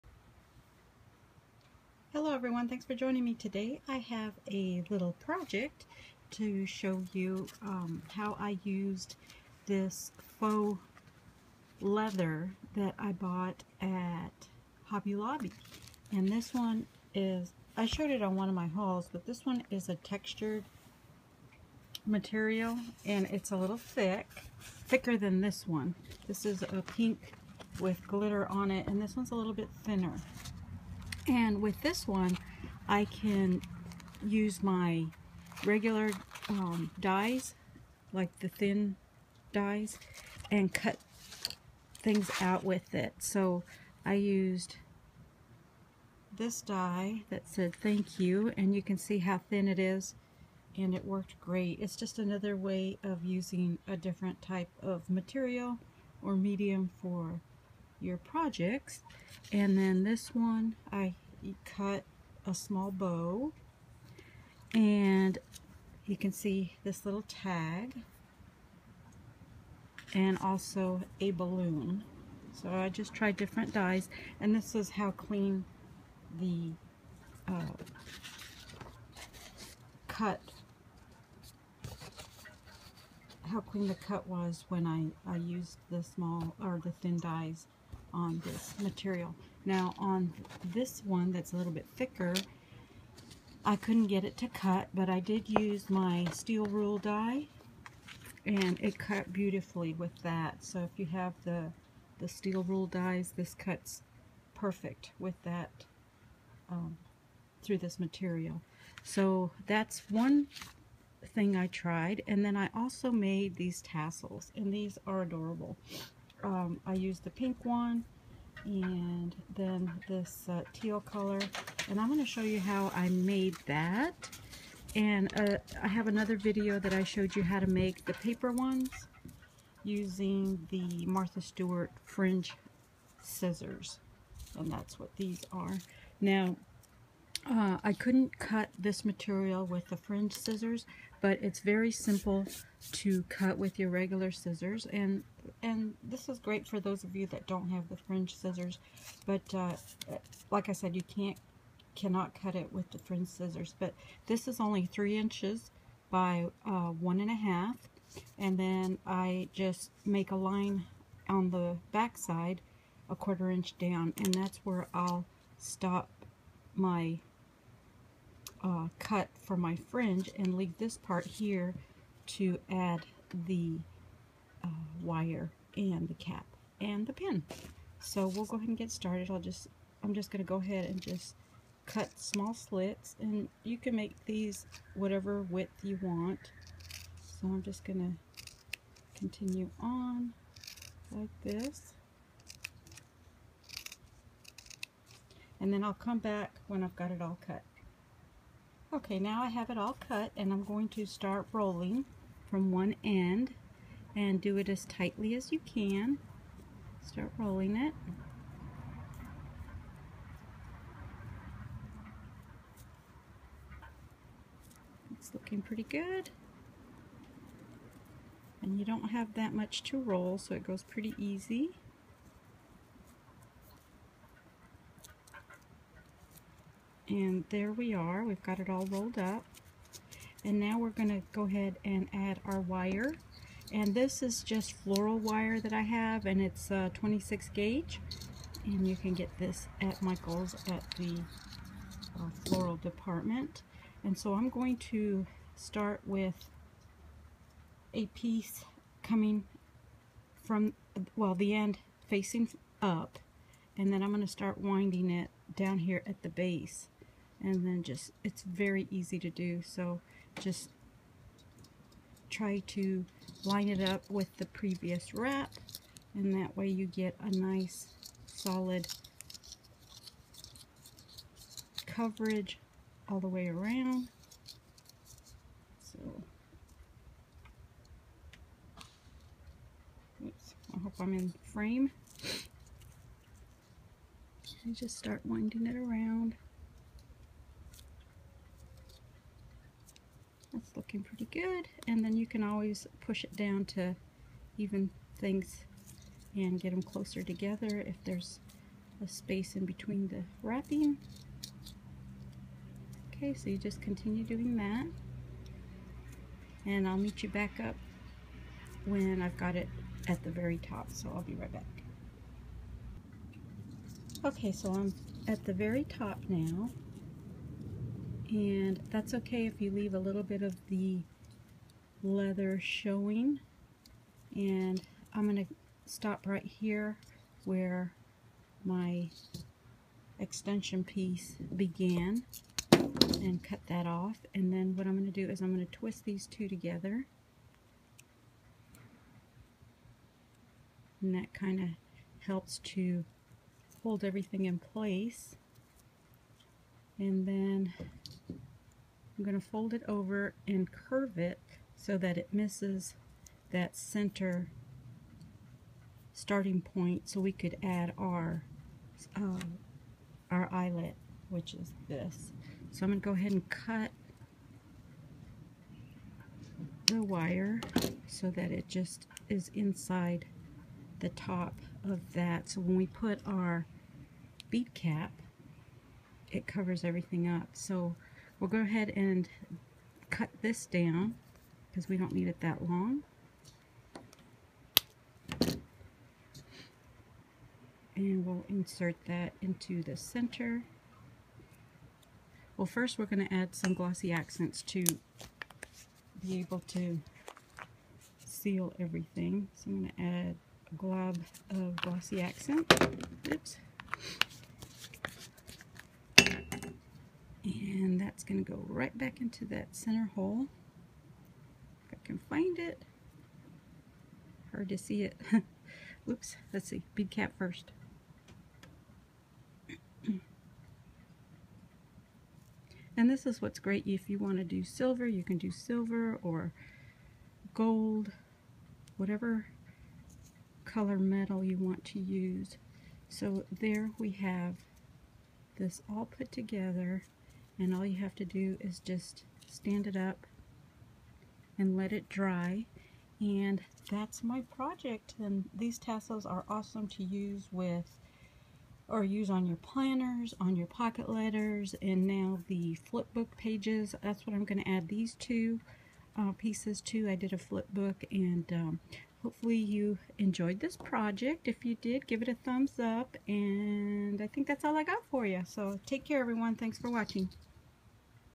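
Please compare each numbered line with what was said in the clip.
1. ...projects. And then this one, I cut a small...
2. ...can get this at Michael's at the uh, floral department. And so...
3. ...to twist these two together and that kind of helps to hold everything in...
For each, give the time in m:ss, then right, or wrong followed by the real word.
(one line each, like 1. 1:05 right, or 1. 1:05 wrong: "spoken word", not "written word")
1. 0:58 right
2. 3:58 right
3. 5:35 right.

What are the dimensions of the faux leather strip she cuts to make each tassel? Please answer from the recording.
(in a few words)
3 inches by 1.5.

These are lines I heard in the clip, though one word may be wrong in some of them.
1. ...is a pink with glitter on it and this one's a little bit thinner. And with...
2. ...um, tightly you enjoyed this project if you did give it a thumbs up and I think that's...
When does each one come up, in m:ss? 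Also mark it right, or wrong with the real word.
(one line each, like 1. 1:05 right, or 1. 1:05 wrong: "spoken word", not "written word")
1. 0:26 right
2. 7:38 wrong: "hopefully", not "tightly".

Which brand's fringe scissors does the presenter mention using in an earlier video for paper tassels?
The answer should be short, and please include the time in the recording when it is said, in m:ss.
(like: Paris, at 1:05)
Martha Stewart, at 2:11.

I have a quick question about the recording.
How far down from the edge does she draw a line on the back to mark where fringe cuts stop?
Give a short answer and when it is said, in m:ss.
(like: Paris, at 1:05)
a quarter inch, at 2:43.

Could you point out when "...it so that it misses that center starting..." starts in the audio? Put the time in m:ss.
5:51.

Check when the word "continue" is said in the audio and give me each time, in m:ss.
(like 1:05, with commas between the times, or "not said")
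3:09, 5:03.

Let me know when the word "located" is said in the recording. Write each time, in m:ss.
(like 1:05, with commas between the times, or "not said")
not said.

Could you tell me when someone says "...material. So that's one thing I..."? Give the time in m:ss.
1:47.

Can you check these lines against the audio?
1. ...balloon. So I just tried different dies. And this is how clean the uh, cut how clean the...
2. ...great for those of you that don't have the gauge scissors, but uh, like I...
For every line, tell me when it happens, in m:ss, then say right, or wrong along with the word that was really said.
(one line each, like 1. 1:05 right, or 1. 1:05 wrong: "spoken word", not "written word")
1. 1:11 right
2. 2:26 wrong: "fringe", not "gauge".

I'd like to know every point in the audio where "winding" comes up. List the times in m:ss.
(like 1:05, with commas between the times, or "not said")
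4:14, 4:45.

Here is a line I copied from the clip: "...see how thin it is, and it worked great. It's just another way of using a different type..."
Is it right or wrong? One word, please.
right.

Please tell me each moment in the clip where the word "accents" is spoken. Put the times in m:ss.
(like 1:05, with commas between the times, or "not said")
6:34, 6:42.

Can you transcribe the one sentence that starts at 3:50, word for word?
And now we're going to go ahead and add our wire.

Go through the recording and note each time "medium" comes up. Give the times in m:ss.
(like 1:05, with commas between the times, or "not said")
0:56.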